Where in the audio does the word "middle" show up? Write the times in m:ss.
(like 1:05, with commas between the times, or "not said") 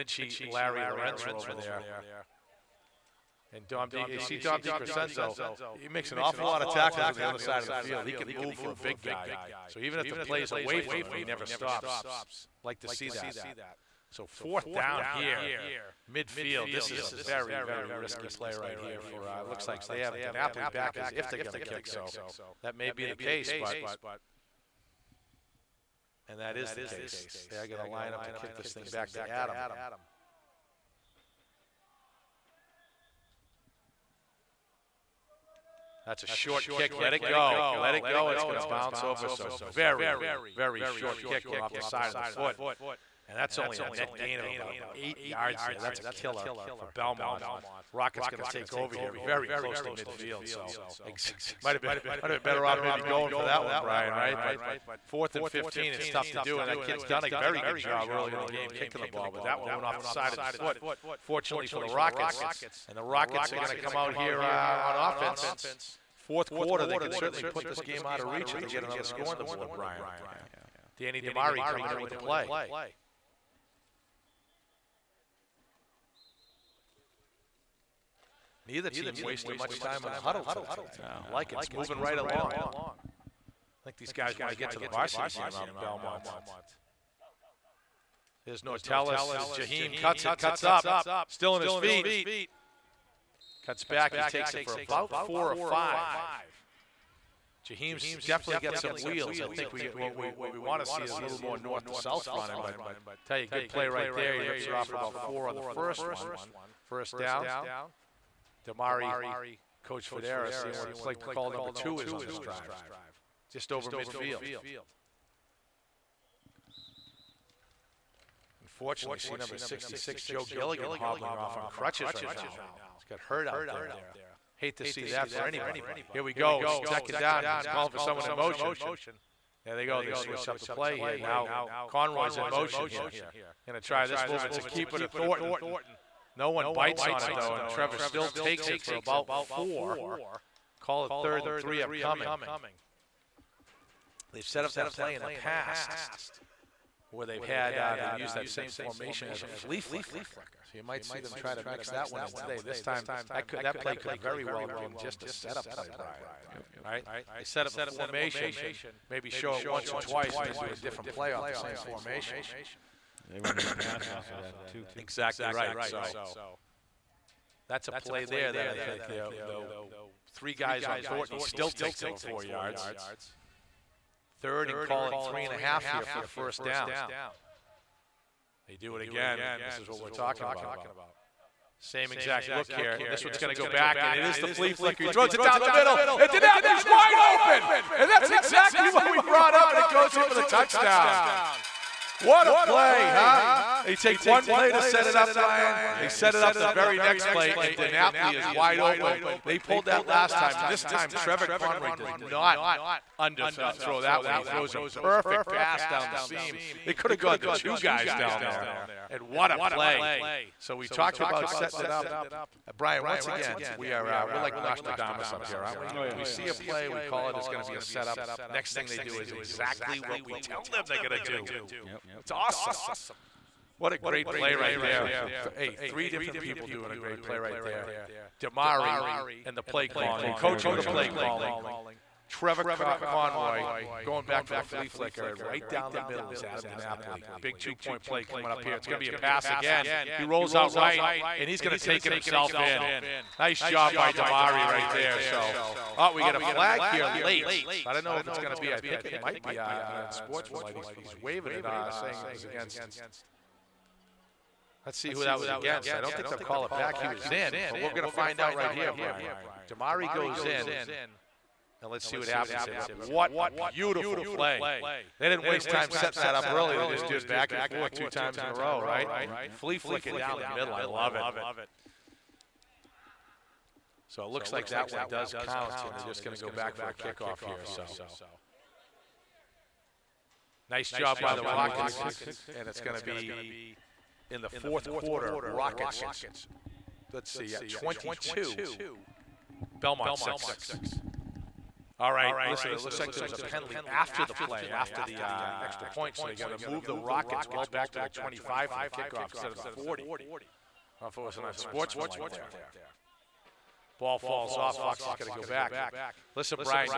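3:05, 3:55, 4:30.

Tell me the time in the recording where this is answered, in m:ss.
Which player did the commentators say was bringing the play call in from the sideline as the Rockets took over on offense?
1:10.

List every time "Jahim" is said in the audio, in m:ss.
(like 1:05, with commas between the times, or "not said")
1:29, 1:37.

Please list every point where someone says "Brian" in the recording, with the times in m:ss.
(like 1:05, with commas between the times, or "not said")
0:53, 1:09, 2:35, 3:15, 3:32, 4:18.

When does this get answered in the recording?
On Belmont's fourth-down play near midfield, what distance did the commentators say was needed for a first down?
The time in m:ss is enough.
0:55.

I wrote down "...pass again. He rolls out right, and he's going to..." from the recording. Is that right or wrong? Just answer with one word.
right.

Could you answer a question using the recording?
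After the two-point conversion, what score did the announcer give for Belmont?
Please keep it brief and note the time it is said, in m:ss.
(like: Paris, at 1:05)
6, at 4:49.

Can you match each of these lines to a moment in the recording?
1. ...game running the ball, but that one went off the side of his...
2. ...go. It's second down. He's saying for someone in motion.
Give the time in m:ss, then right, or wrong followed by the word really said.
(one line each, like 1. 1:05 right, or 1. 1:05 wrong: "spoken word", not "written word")
1. 0:58 wrong: "kicking", not "running"
2. 2:06 wrong: "calling", not "saying".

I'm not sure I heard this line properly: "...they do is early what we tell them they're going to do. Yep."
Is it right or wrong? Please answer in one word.
wrong.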